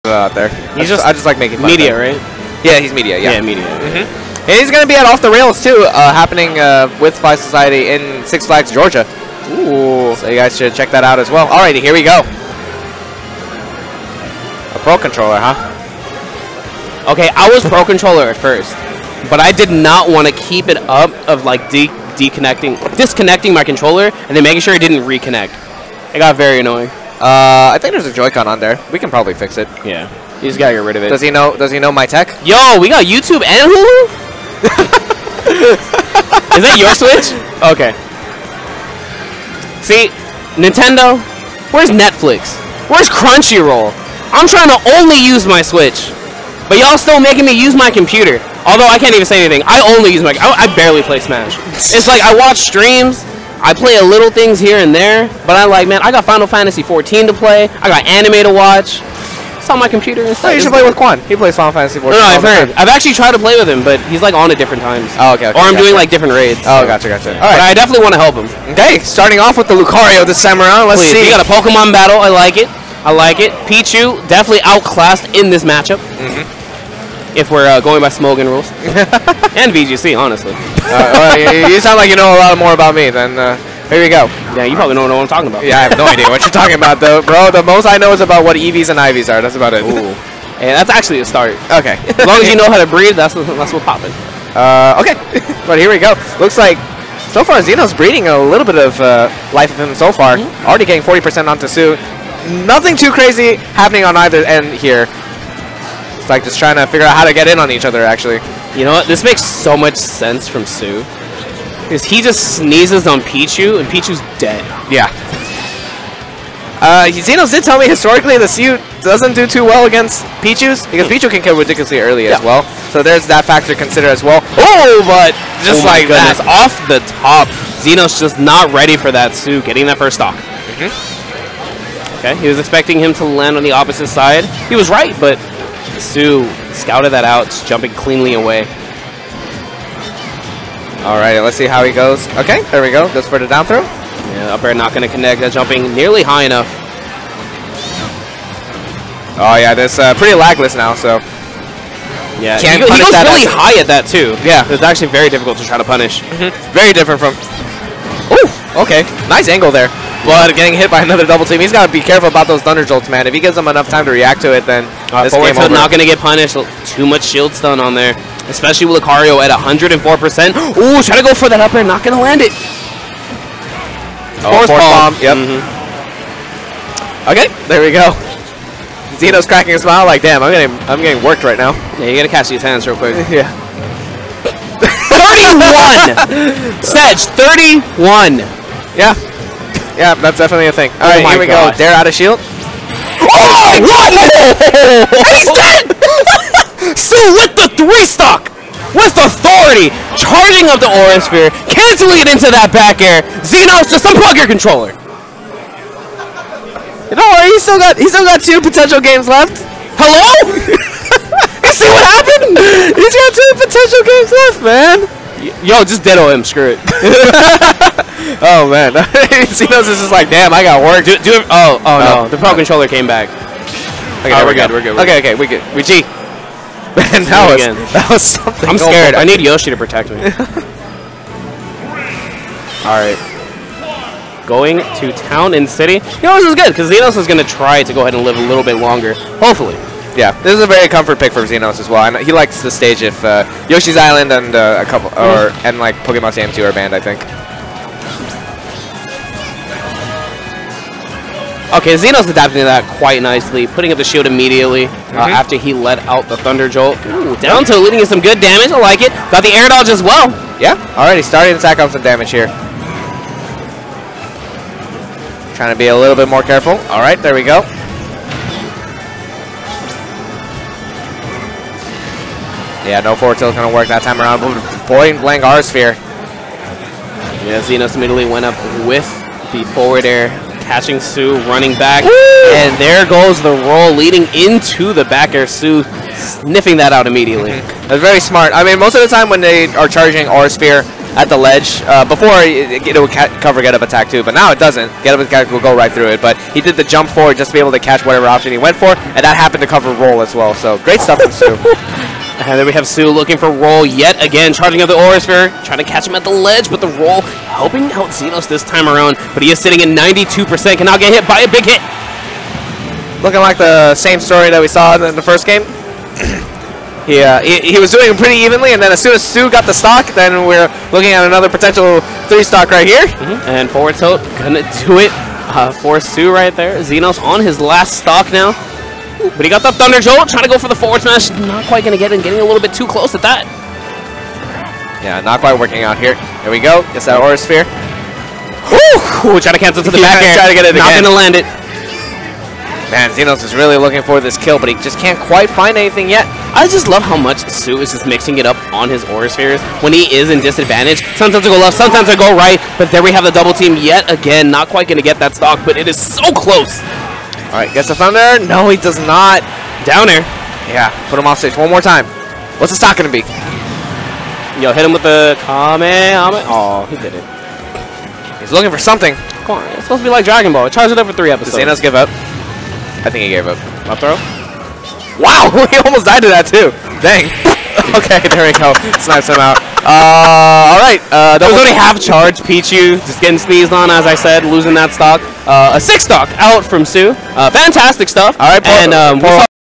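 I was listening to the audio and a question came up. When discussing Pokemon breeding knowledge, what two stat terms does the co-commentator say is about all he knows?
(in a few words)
EVs and IVs.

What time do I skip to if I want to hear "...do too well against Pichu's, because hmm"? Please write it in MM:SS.
01:59.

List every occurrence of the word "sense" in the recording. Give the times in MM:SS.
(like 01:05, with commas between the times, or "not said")
01:49.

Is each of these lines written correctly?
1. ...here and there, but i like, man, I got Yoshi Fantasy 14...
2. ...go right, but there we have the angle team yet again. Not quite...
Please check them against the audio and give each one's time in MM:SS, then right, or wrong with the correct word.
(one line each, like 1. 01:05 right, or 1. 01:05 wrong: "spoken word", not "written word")
1. 00:54 wrong: "Final", not "Yoshi"
2. 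05:52 wrong: "double", not "angle".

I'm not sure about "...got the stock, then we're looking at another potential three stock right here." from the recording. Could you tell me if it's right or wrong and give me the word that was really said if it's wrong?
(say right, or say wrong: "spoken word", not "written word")
right.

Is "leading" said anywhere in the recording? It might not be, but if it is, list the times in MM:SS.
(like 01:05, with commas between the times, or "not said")
04:17, 04:43.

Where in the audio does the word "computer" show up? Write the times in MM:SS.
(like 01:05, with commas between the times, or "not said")
00:47, 00:59.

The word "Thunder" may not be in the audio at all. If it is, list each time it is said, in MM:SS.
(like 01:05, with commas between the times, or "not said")
02:42, 04:16, 05:29, 05:57.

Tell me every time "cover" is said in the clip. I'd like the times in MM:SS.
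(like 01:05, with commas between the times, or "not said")
04:53, 04:59.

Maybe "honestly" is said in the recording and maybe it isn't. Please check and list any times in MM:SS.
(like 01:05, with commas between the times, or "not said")
01:20.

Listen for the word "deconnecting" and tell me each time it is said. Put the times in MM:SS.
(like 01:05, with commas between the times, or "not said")
00:22.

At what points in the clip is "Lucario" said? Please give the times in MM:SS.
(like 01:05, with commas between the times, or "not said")
01:09, 02:49.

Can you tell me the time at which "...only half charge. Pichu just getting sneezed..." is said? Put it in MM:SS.
06:21.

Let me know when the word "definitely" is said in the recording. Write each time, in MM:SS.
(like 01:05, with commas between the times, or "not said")
01:07, 01:14, 03:10.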